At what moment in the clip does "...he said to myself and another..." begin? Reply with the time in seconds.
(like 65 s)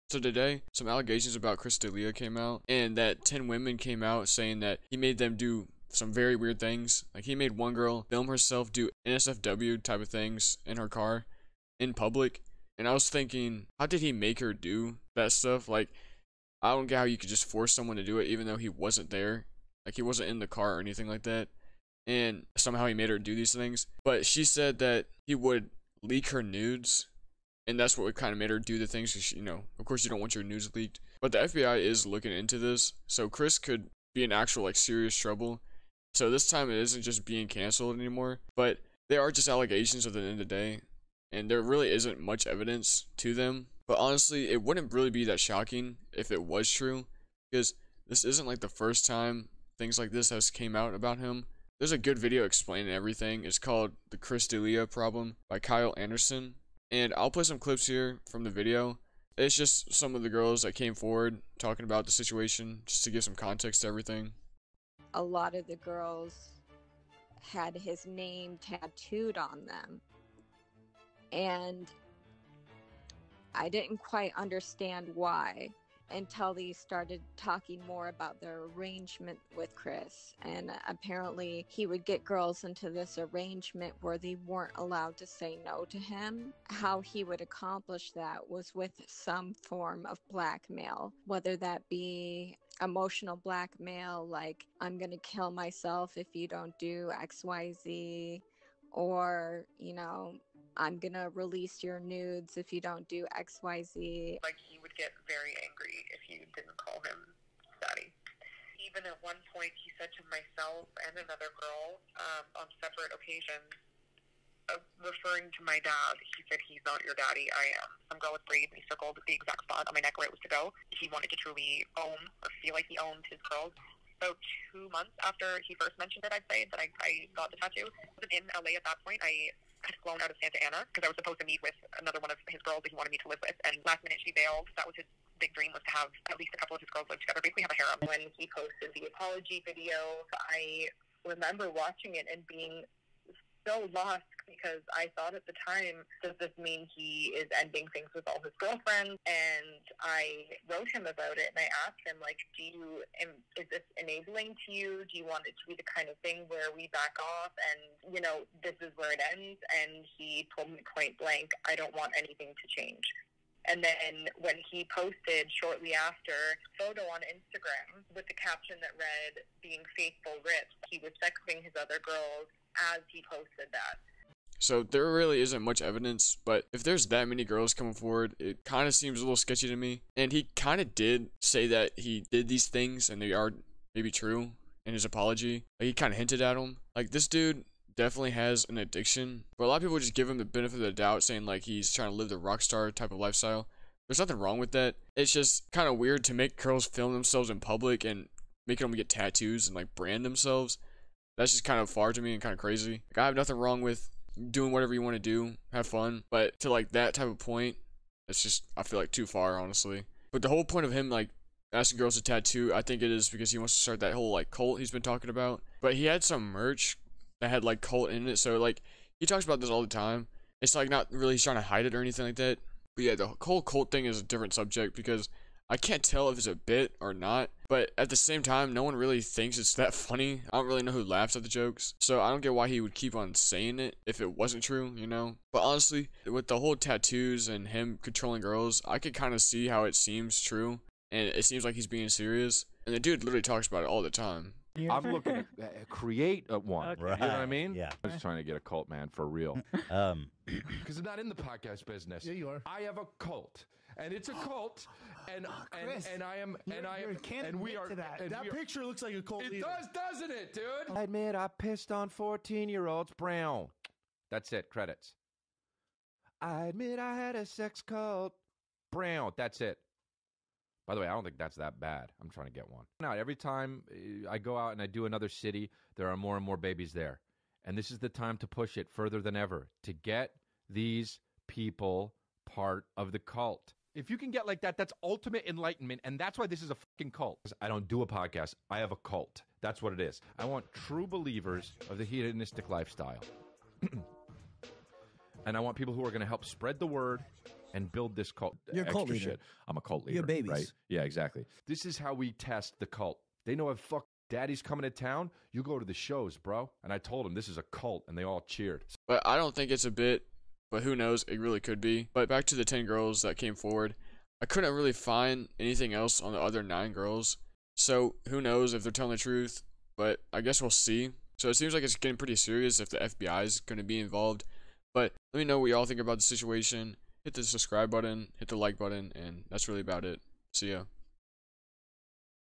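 109 s.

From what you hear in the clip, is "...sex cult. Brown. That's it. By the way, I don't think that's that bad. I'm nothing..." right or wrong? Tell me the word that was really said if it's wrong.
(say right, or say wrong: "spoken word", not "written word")
wrong: "trying", not "nothing".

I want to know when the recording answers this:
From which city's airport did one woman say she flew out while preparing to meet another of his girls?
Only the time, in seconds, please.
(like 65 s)
130 s.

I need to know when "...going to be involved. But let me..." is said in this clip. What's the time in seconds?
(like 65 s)
323 s.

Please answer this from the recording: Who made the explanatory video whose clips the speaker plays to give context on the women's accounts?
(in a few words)
Kyle Anderson.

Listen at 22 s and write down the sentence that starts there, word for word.
And somehow he made her do these things.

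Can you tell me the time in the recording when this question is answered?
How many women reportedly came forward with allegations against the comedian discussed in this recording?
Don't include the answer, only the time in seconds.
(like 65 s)
3 s.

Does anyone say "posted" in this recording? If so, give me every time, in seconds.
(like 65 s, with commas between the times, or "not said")
138 s, 164 s, 173 s.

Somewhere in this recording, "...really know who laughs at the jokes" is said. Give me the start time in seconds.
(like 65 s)
230 s.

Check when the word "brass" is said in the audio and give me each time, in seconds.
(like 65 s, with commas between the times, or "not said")
not said.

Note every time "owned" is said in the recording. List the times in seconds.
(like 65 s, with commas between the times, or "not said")
122 s.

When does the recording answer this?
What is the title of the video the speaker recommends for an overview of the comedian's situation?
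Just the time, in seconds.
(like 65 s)
54 s.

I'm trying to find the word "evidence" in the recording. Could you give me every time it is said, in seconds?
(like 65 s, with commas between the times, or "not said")
42 s, 175 s.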